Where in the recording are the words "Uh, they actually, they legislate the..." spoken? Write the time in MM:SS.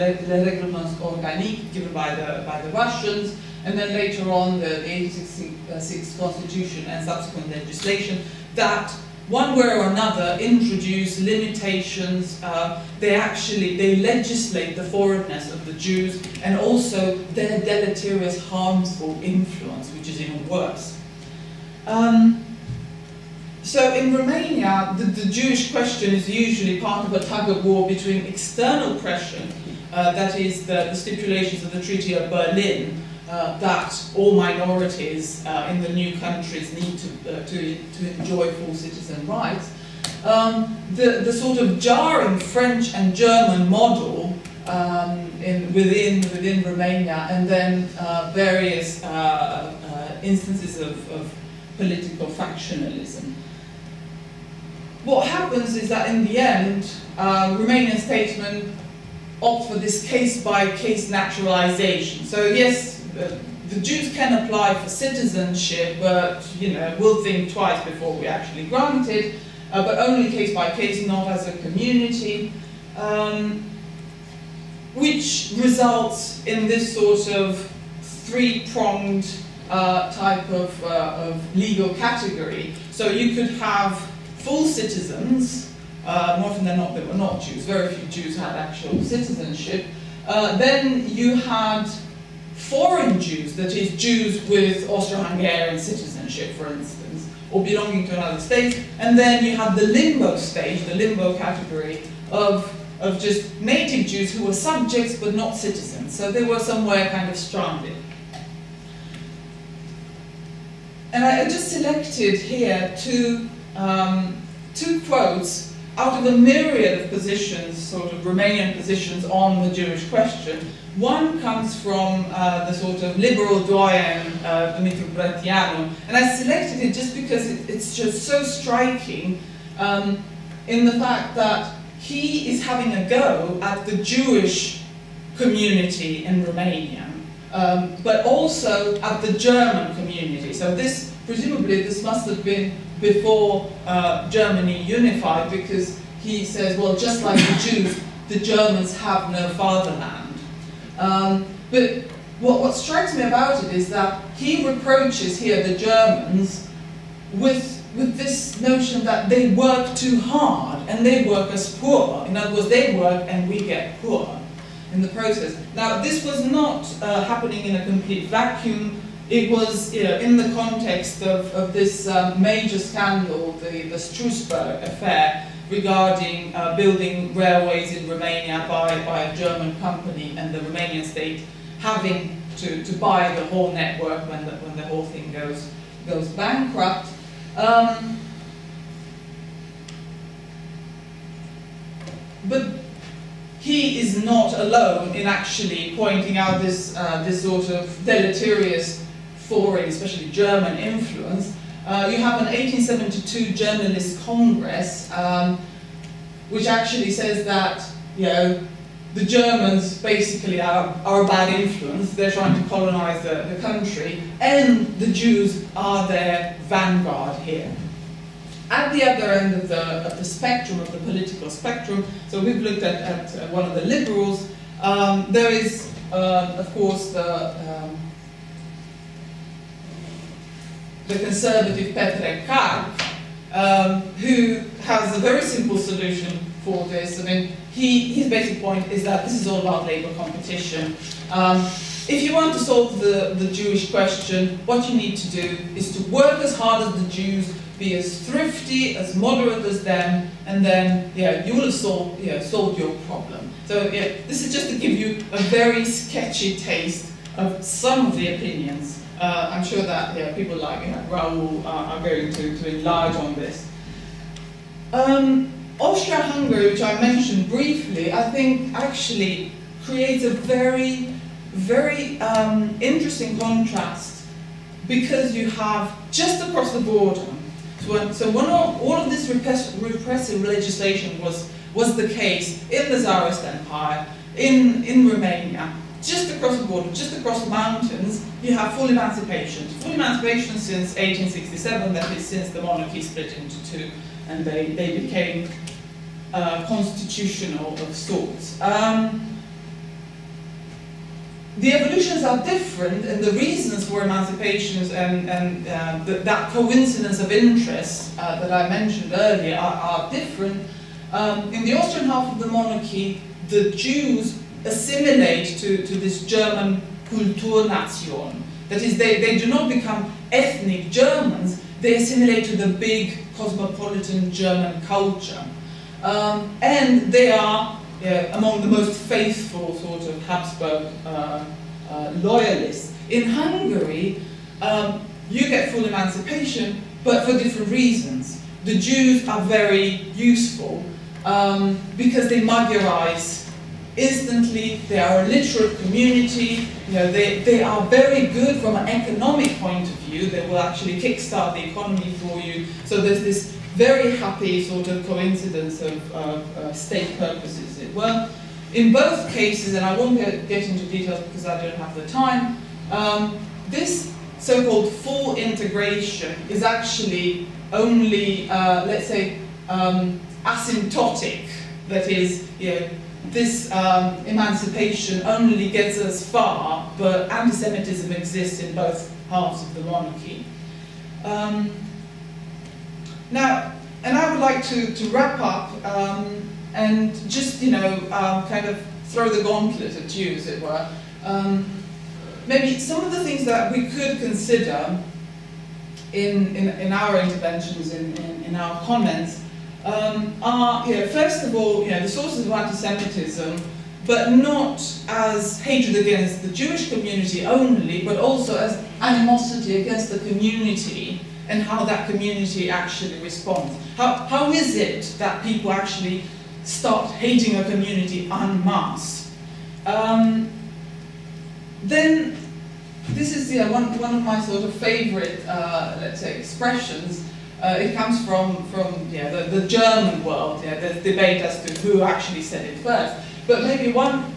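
00:12.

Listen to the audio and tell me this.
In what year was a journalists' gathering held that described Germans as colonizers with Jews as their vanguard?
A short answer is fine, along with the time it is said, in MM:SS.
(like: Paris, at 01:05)
1872, at 03:22.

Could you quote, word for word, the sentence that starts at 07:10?
Yeah, the debate as to who actually said it first.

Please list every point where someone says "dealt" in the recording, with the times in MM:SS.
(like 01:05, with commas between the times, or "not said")
not said.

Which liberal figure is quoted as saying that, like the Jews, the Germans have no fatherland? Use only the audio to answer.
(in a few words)
Dumitru Bratianu.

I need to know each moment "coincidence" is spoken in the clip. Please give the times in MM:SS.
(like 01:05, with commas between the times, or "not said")
05:06, 05:55.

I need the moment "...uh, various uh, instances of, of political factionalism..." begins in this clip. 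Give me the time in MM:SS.
00:47.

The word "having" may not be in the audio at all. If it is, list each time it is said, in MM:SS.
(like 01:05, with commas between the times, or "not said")
02:12, 03:01.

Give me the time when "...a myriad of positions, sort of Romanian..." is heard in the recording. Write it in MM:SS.
01:56.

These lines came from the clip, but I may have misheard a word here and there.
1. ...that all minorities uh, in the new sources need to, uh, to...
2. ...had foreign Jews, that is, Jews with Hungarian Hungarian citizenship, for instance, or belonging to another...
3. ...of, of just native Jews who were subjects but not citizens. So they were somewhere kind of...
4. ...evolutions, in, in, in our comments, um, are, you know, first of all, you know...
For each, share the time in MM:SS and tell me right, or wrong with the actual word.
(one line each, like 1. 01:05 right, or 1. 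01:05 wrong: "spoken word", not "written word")
1. 00:33 wrong: "countries", not "sources"
2. 01:31 wrong: "Austro", not "Hungarian"
3. 01:42 right
4. 06:37 wrong: "interventions", not "evolutions".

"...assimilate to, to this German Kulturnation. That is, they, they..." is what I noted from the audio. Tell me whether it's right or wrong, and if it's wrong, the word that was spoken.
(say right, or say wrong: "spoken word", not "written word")
right.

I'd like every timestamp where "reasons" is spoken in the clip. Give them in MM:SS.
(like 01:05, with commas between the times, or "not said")
05:03, 05:37.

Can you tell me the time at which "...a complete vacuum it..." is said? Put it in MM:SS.
02:47.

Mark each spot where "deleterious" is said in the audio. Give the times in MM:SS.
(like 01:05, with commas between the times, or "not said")
00:17, 03:18.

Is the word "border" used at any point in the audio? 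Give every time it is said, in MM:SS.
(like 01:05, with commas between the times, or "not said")
04:36, 04:46.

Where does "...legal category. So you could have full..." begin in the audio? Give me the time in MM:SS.
01:21.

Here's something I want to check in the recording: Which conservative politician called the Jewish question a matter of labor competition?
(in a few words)
Petre Carp.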